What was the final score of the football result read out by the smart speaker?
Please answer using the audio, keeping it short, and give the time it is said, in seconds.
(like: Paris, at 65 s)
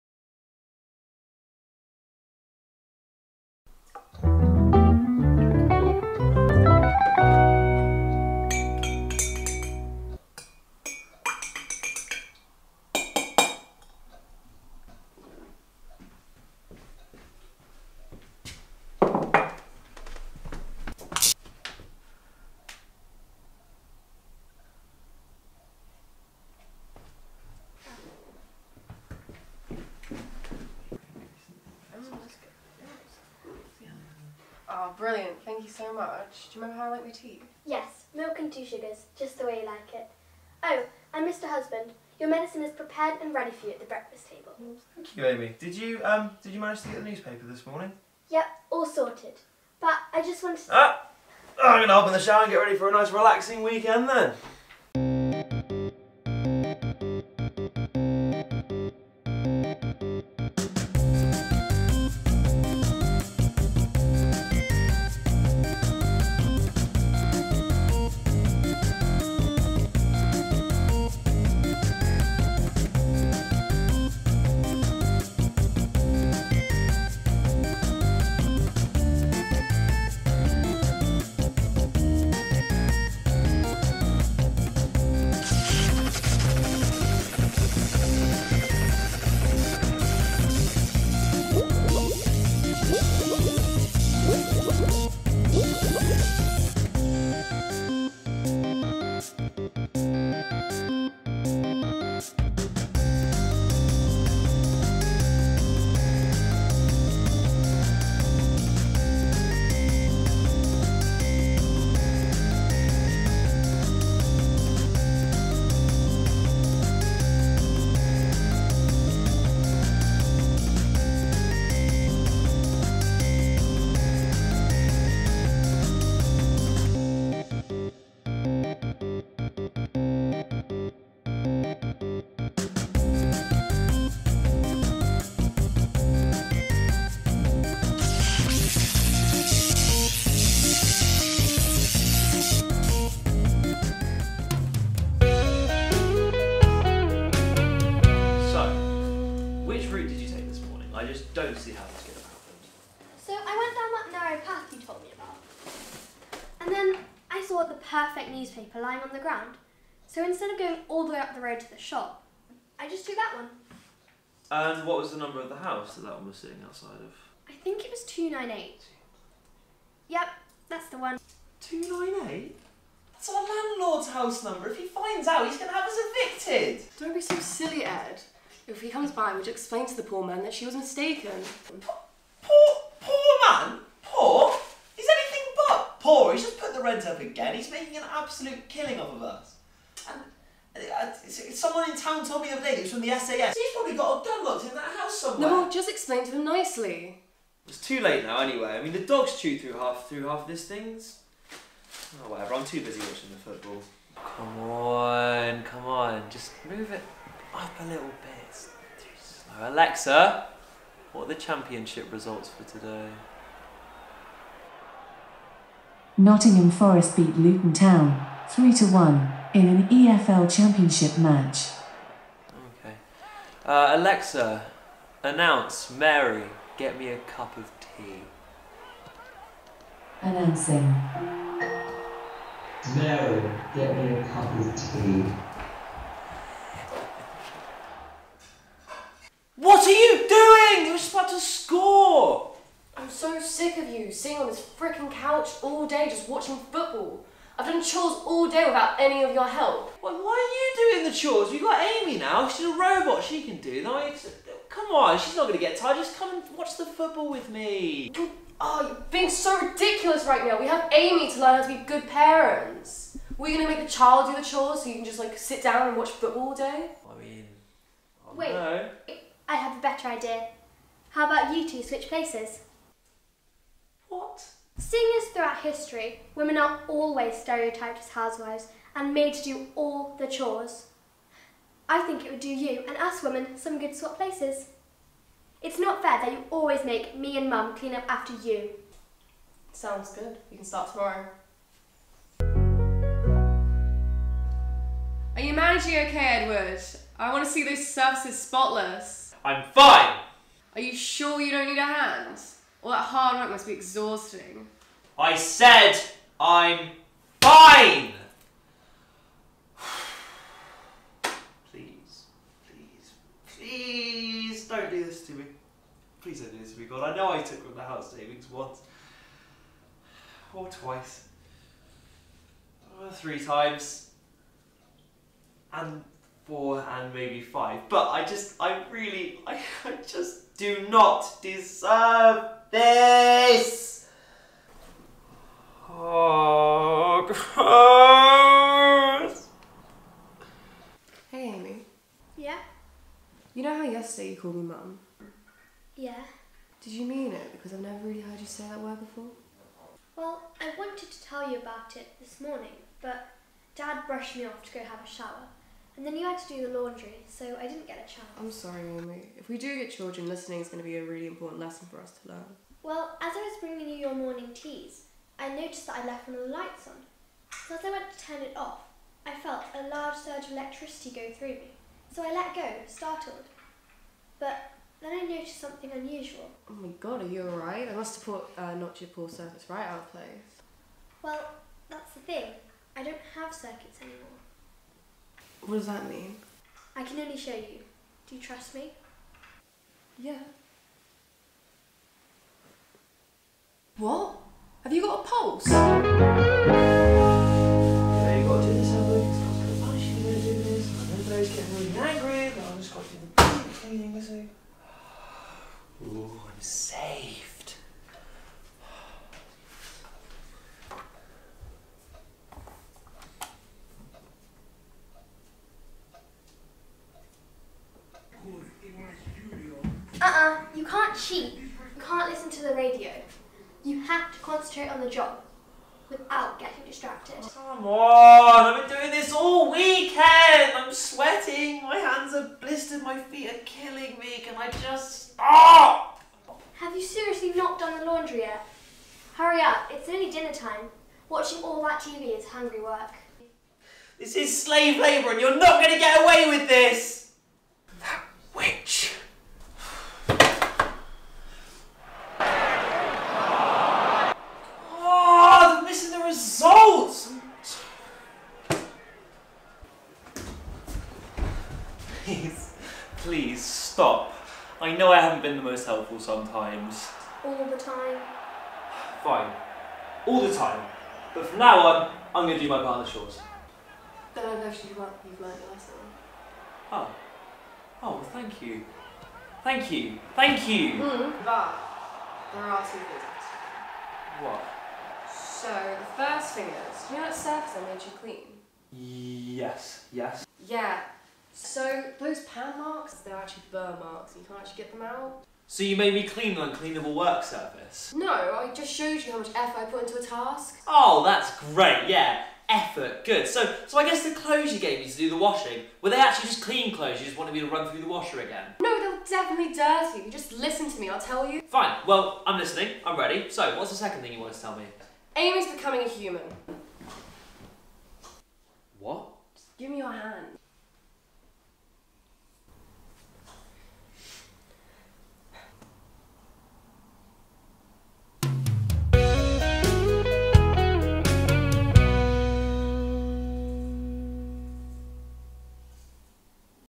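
3 to 1, at 218 s.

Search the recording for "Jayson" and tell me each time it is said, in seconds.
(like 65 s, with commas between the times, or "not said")
not said.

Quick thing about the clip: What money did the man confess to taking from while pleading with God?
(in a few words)
House savings.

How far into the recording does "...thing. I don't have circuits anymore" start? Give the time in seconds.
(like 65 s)
382 s.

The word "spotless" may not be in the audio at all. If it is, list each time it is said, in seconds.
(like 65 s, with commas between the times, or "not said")
298 s.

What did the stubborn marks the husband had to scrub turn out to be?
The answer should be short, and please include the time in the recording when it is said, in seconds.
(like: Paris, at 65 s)
Burn marks, at 493 s.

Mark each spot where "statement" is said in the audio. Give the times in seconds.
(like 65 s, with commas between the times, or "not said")
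not said.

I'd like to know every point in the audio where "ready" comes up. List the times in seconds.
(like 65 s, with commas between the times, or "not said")
43 s, 52 s, 513 s.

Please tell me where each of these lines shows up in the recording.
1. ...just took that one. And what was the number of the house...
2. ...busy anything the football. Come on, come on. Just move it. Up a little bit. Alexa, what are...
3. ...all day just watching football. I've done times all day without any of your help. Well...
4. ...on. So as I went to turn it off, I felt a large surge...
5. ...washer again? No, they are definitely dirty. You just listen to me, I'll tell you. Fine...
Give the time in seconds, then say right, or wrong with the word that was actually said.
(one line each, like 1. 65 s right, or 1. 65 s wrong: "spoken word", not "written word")
1. 162 s right
2. 202 s wrong: "watching", not "anything"
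3. 245 s wrong: "chores", not "times"
4. 366 s right
5. 508 s right.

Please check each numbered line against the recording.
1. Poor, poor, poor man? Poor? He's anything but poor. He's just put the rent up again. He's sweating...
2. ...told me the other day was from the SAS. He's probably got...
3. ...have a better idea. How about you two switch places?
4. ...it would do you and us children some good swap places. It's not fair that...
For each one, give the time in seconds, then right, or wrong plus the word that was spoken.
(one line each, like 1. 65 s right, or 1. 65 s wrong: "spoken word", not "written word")
1. 181 s wrong: "making", not "sweating"
2. 192 s right
3. 269 s right
4. 282 s wrong: "women", not "children".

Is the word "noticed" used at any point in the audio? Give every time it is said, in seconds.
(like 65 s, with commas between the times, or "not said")
365 s, 375 s.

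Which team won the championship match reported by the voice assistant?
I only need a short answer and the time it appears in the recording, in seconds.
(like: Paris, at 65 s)
Nottingham Forest, at 216 s.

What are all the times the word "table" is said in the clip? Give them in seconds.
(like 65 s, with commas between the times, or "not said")
44 s.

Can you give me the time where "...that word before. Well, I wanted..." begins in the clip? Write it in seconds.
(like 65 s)
348 s.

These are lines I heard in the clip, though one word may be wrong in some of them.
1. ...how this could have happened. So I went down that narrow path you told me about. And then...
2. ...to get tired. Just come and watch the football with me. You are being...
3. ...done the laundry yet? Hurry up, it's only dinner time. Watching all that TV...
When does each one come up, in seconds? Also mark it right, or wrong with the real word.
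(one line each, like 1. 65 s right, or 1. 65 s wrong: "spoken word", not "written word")
1. 151 s right
2. 255 s right
3. 437 s right.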